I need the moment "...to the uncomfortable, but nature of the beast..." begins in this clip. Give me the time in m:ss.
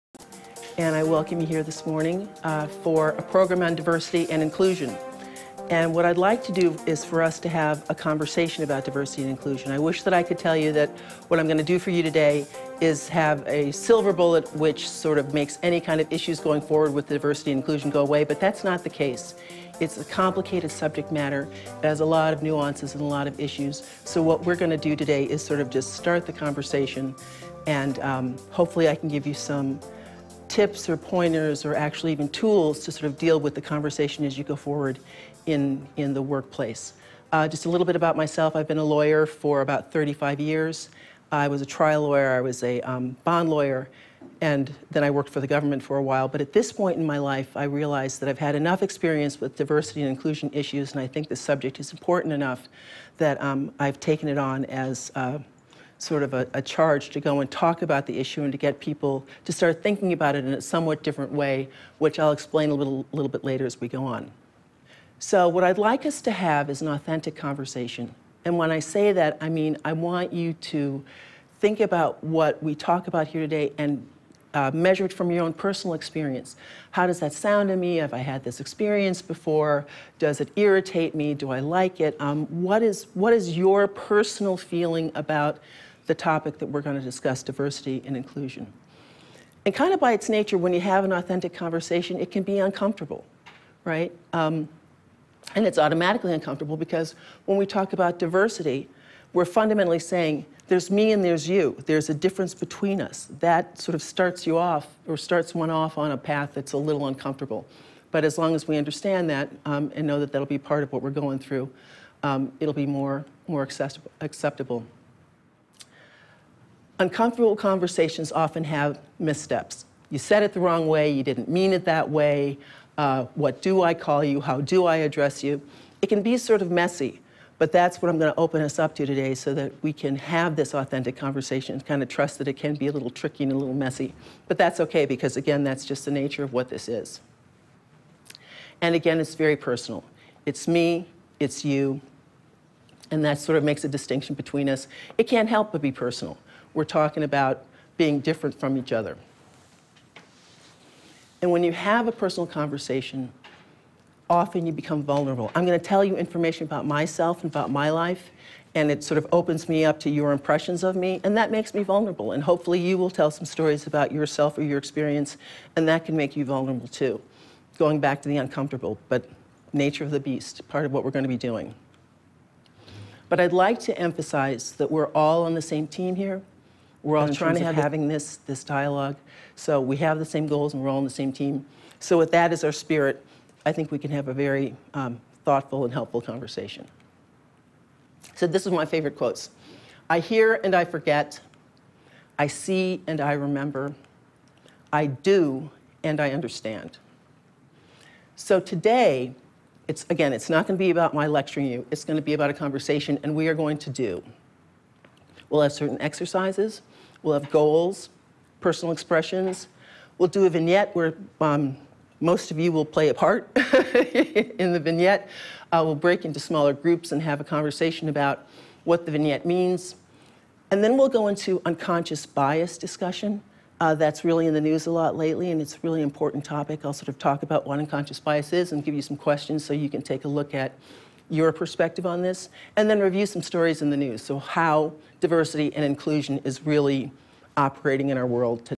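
2:48.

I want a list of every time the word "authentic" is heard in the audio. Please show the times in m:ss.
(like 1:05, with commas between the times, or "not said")
1:06, 1:31, 2:10.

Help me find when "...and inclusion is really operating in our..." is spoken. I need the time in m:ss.
3:55.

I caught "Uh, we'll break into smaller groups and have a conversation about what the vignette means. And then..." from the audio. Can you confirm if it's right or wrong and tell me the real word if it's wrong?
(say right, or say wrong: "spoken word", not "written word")
right.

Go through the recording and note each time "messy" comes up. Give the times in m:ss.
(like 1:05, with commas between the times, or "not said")
2:06, 2:13.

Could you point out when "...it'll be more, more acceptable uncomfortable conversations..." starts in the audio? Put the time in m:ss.
1:52.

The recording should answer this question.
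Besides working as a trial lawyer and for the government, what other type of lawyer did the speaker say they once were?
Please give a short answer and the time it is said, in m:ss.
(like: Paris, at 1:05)
bond lawyer, at 0:43.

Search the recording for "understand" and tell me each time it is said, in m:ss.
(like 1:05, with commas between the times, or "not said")
1:48, 3:16.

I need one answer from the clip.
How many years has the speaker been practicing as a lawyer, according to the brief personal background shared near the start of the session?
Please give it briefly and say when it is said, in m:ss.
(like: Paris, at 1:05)
35, at 0:39.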